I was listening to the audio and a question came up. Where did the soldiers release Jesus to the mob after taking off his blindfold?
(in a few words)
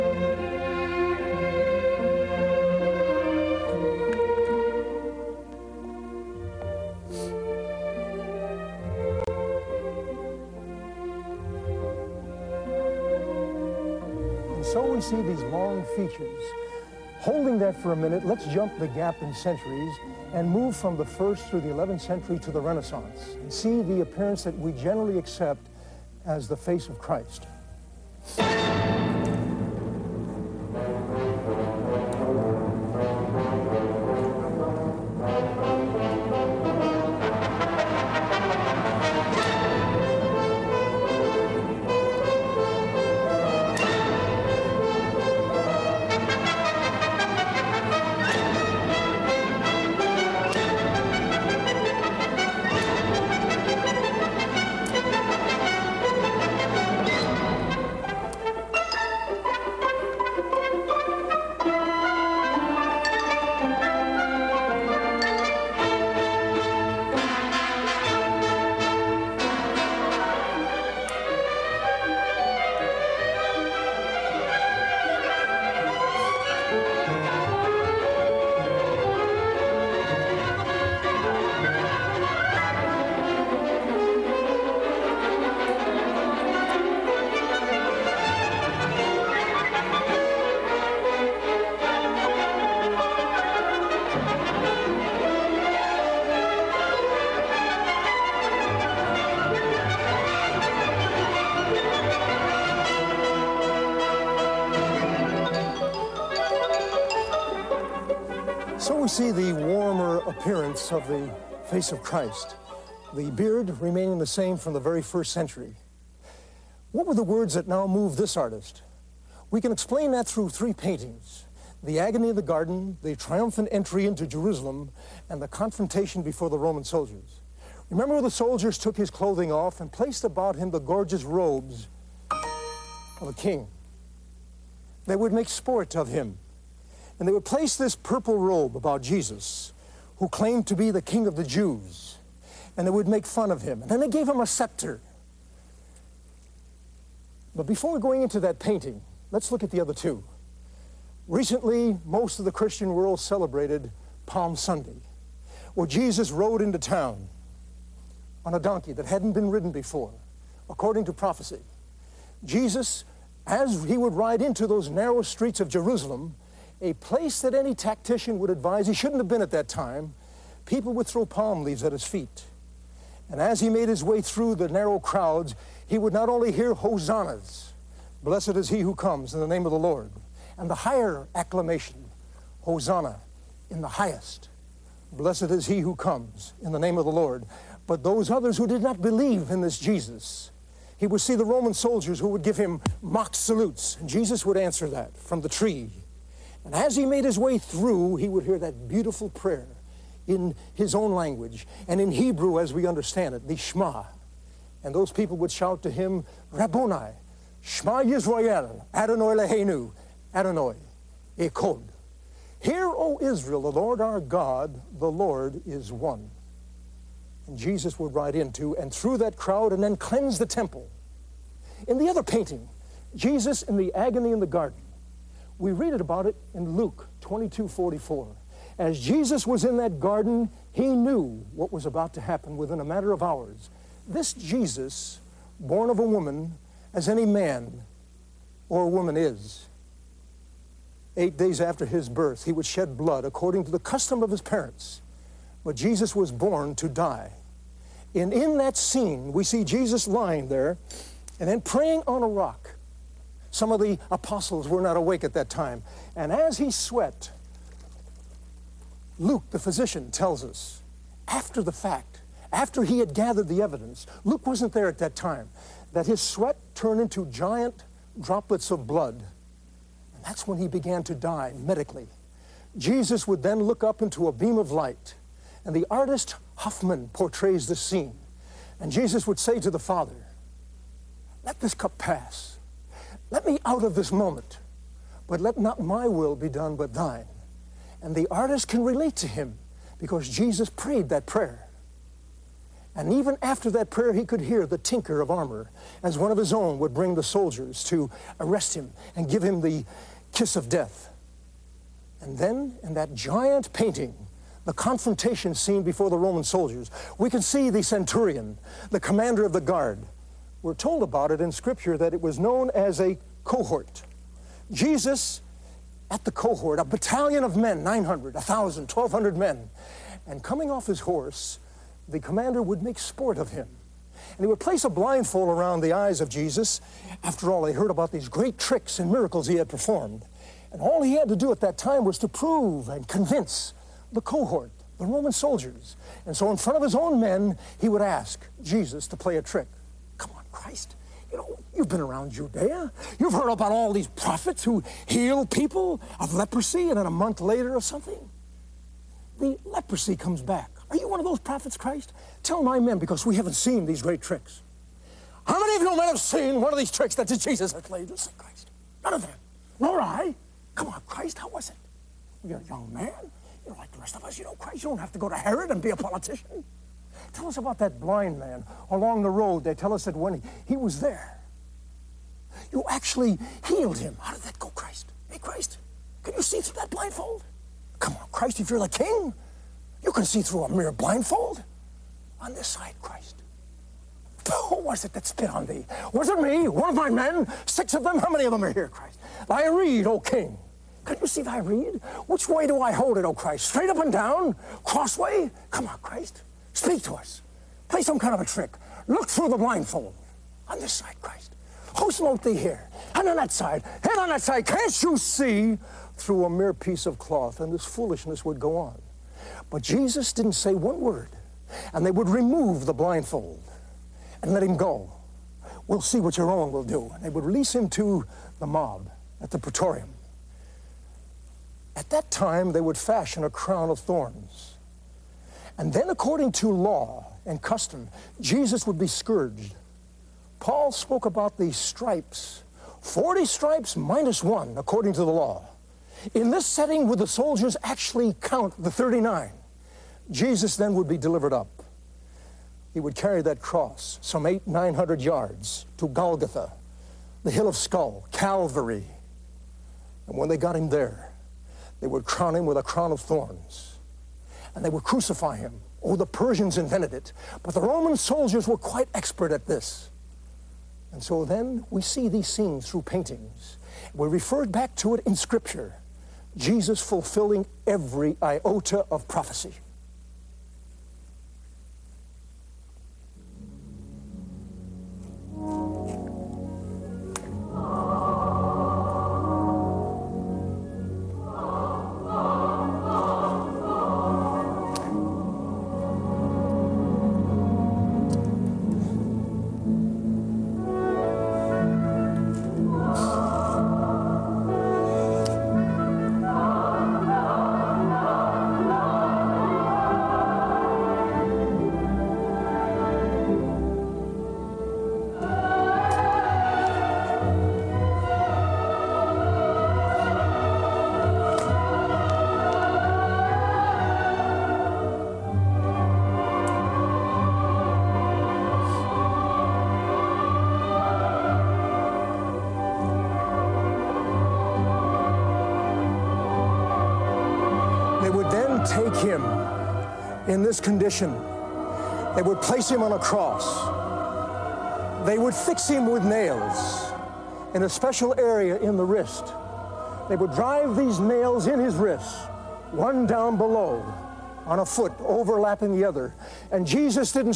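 The praetorium.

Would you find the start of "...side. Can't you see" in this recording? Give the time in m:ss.
6:44.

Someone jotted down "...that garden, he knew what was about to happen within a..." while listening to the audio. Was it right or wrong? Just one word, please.
right.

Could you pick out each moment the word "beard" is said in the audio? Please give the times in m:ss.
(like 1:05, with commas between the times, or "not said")
1:53.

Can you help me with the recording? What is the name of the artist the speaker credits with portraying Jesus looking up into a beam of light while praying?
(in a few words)
Hofmann.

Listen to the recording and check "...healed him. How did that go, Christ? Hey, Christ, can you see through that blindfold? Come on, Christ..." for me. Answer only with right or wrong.
right.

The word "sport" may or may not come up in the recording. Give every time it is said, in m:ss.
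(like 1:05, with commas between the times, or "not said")
2:15, 5:22.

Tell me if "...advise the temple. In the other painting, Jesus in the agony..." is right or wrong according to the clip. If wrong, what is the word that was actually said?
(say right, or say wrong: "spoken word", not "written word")
wrong: "cleanse", not "advise".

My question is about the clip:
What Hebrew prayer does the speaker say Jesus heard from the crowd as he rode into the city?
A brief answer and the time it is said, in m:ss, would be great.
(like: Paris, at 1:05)
The Shema, at 3:23.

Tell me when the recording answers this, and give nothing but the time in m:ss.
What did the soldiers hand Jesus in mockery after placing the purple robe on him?
2:24.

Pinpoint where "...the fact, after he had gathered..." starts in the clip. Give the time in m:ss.
4:21.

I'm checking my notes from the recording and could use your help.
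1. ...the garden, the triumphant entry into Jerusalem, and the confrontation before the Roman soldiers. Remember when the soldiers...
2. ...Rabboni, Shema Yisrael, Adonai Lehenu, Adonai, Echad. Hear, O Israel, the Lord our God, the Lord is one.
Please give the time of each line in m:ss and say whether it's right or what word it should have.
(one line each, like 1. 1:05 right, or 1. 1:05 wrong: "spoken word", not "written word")
1. 2:02 right
2. 3:26 right.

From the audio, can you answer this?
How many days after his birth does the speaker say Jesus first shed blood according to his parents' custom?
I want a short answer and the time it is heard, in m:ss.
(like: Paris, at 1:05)
8, at 4:01.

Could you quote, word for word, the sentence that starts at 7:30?
And when they got him there, they would crown him with a crown of thorns and they would crucify him.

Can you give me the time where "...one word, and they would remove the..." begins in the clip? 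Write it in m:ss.
6:50.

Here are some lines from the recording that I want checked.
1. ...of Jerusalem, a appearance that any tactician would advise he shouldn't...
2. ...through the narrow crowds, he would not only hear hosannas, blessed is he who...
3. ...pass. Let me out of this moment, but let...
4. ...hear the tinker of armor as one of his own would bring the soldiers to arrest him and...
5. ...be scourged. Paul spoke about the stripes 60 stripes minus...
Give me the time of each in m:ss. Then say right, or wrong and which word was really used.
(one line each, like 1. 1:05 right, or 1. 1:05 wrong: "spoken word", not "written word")
1. 2:45 wrong: "place", not "appearance"
2. 2:54 right
3. 4:41 right
4. 4:54 right
5. 7:08 wrong: "40", not "60".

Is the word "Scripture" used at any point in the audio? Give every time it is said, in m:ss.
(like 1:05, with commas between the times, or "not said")
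5:11, 7:45.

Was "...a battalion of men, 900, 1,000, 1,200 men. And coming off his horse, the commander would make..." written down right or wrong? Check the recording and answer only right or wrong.
right.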